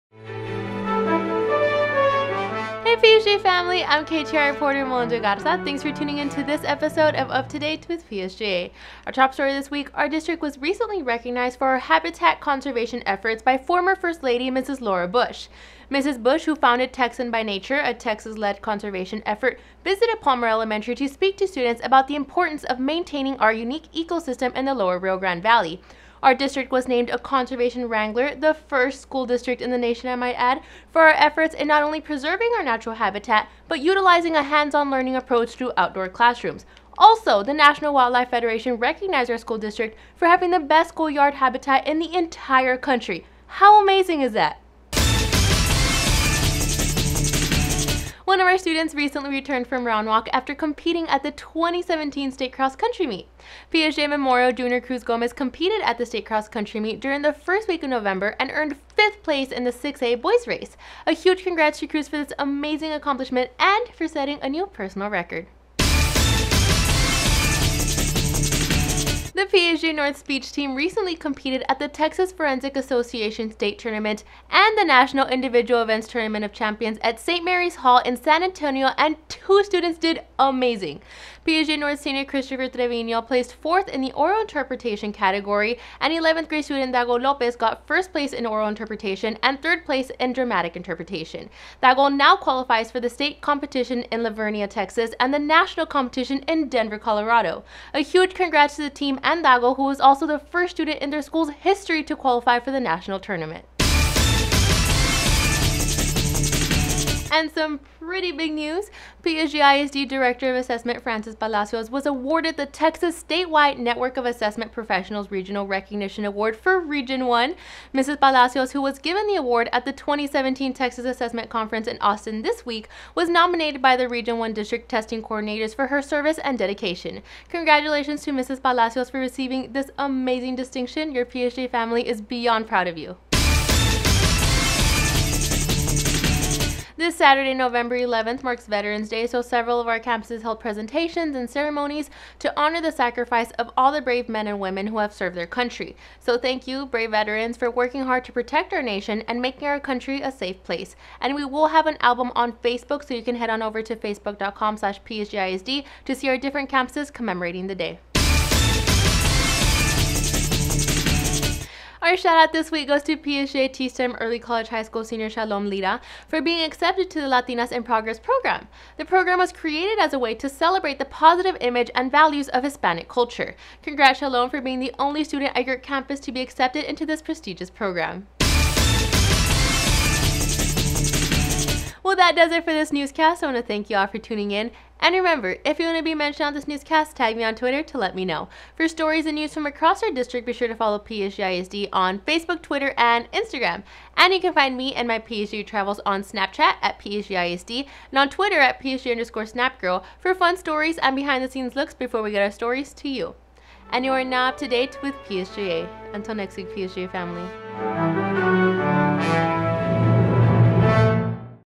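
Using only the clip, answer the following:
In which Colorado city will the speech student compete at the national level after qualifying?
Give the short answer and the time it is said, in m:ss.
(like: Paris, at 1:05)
Denver, at 1:36.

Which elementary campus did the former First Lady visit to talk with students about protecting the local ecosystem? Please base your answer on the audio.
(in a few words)
Palmer Elementary.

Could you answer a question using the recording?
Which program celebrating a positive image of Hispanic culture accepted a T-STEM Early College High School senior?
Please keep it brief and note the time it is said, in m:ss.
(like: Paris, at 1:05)
Latinas in Progress, at 2:47.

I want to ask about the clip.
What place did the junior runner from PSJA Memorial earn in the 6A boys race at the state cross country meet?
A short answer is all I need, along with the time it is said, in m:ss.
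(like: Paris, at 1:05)
5th place, at 0:58.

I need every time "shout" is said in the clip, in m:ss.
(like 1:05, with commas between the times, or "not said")
2:42.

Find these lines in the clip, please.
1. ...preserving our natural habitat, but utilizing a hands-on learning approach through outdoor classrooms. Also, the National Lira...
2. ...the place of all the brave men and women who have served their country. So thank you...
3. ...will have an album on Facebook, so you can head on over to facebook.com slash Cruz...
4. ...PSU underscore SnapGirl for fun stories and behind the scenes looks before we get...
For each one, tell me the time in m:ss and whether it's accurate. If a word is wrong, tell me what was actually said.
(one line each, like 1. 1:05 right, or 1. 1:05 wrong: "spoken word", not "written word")
1. 0:31 wrong: "Wildlife", not "Lira"
2. 2:22 wrong: "sacrifice", not "place"
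3. 2:31 wrong: "PSJAISD", not "Cruz"
4. 3:18 right.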